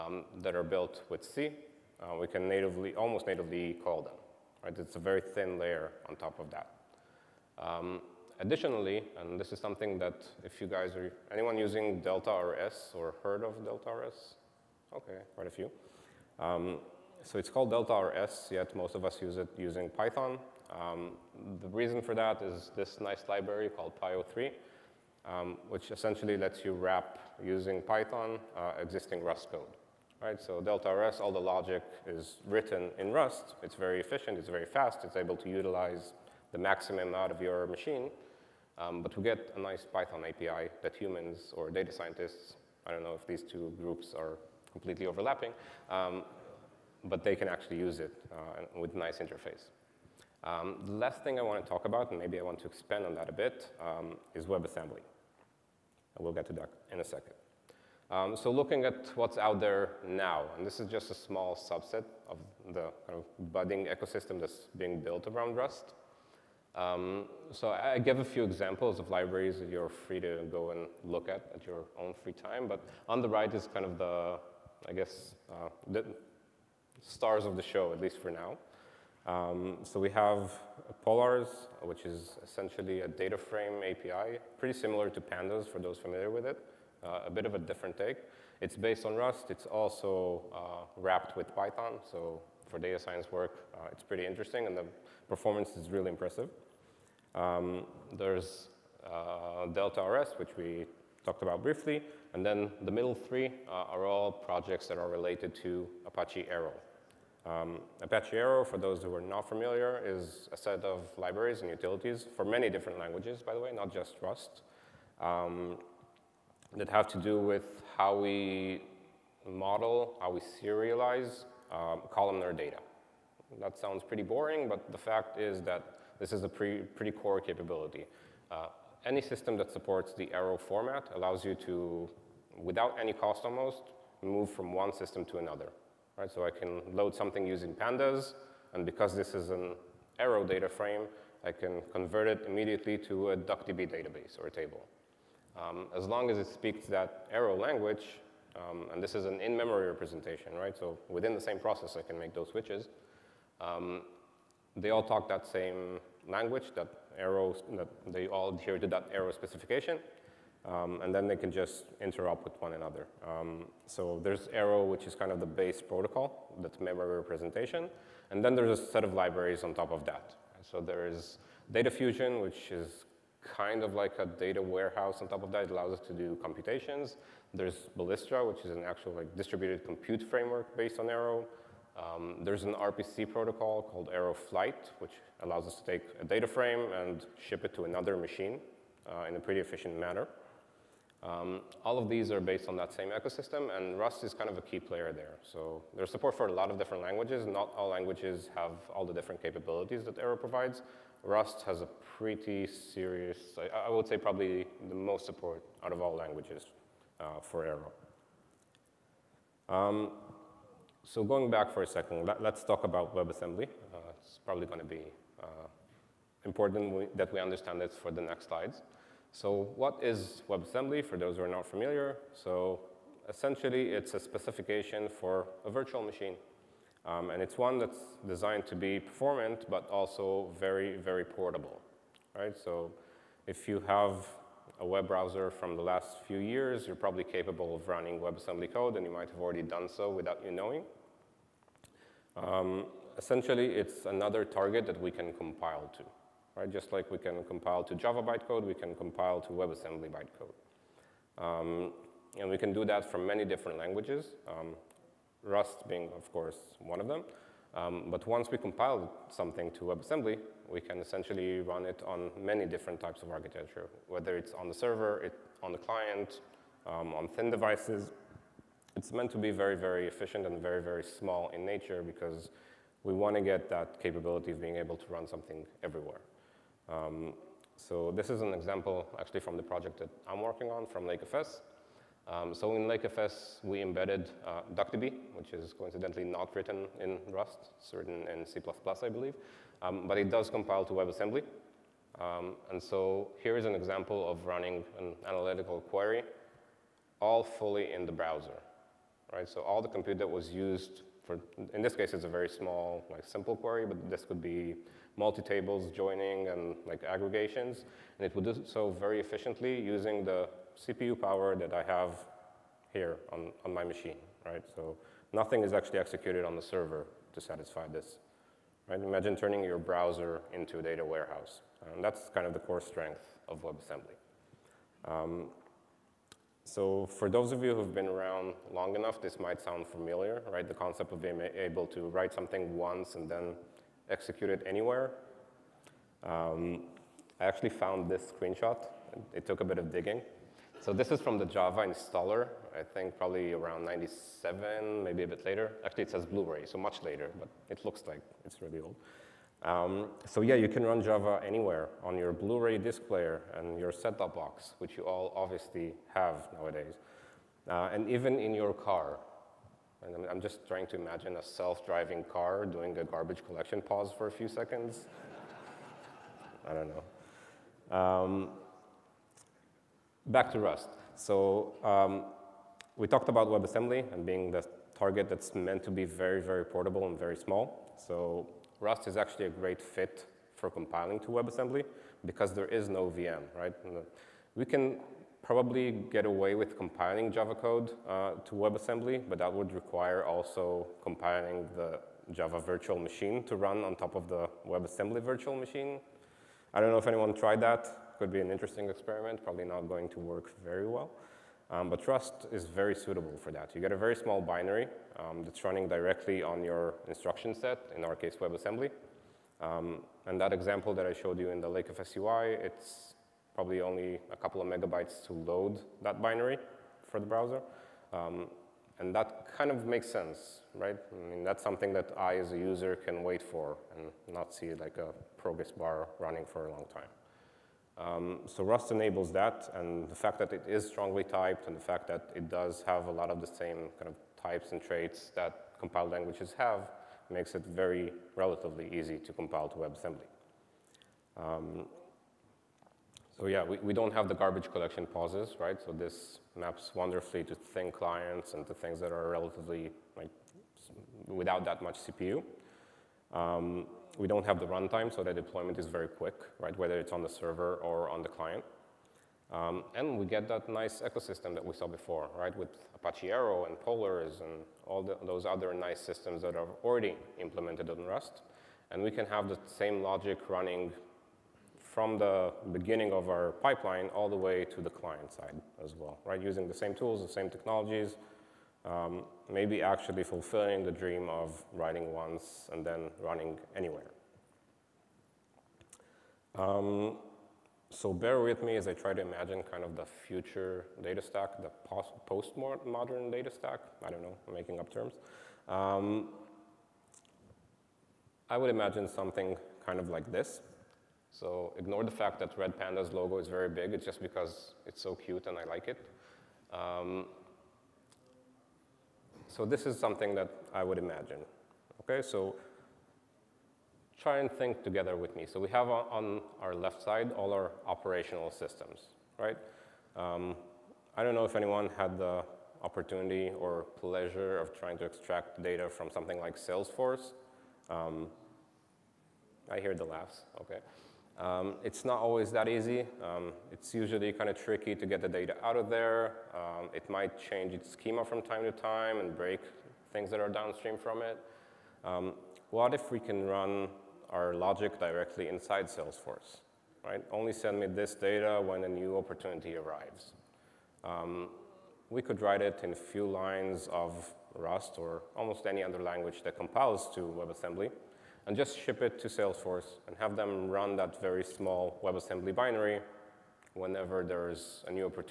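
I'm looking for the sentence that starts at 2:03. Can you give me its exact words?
That sounds pretty boring, but the fact is that this is a pre pretty core capability.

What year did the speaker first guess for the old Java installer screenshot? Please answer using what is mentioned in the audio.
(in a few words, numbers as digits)
1997.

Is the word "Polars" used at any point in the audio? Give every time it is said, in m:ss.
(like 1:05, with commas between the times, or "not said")
1:21, 7:43.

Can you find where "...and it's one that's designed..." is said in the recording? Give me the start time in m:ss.
3:47.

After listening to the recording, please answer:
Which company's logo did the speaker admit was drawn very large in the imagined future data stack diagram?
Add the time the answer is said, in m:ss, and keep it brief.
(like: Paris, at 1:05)
Redpanda, at 8:22.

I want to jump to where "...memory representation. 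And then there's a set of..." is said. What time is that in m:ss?
2:46.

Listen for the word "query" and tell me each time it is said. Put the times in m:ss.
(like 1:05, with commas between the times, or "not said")
4:55, 5:03.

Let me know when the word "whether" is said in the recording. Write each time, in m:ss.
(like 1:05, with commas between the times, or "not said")
4:24, 7:36.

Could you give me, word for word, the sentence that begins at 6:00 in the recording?
And I'm, I'm just trying to imagine a self-driving car doing a garbage collection pause for a few seconds.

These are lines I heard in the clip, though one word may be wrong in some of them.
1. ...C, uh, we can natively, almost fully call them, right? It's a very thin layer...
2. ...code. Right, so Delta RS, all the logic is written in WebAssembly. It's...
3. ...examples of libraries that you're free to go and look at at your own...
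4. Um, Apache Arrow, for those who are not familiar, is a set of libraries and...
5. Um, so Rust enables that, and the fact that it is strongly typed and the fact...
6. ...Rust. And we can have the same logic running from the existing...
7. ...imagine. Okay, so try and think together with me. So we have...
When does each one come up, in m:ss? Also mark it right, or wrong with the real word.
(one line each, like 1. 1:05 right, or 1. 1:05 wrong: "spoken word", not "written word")
1. 0:01 wrong: "natively", not "fully"
2. 0:29 wrong: "Rust", not "WebAssembly"
3. 1:08 right
4. 1:47 right
5. 7:07 right
6. 7:48 wrong: "beginning", not "existing"
7. 8:30 right.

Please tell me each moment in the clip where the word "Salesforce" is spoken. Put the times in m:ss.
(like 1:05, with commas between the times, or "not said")
8:46, 9:05, 9:19.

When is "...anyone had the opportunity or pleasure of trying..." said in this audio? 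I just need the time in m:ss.
8:41.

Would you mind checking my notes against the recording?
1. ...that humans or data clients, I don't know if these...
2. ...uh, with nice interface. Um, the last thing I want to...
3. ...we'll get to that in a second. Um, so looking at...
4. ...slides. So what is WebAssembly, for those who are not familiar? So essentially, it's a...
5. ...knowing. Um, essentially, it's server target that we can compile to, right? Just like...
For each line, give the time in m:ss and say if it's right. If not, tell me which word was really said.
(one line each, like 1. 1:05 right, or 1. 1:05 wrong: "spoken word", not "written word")
1. 0:40 wrong: "scientists", not "clients"
2. 0:48 right
3. 0:56 right
4. 3:38 right
5. 4:00 wrong: "another", not "server".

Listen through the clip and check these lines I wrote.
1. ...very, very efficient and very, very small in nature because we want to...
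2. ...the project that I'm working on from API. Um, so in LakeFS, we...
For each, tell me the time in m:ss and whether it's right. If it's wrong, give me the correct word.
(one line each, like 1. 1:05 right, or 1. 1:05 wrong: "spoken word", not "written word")
1. 4:29 right
2. 4:39 wrong: "LakeFS", not "API".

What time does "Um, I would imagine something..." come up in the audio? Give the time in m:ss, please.
8:15.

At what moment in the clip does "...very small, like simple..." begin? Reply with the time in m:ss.
5:02.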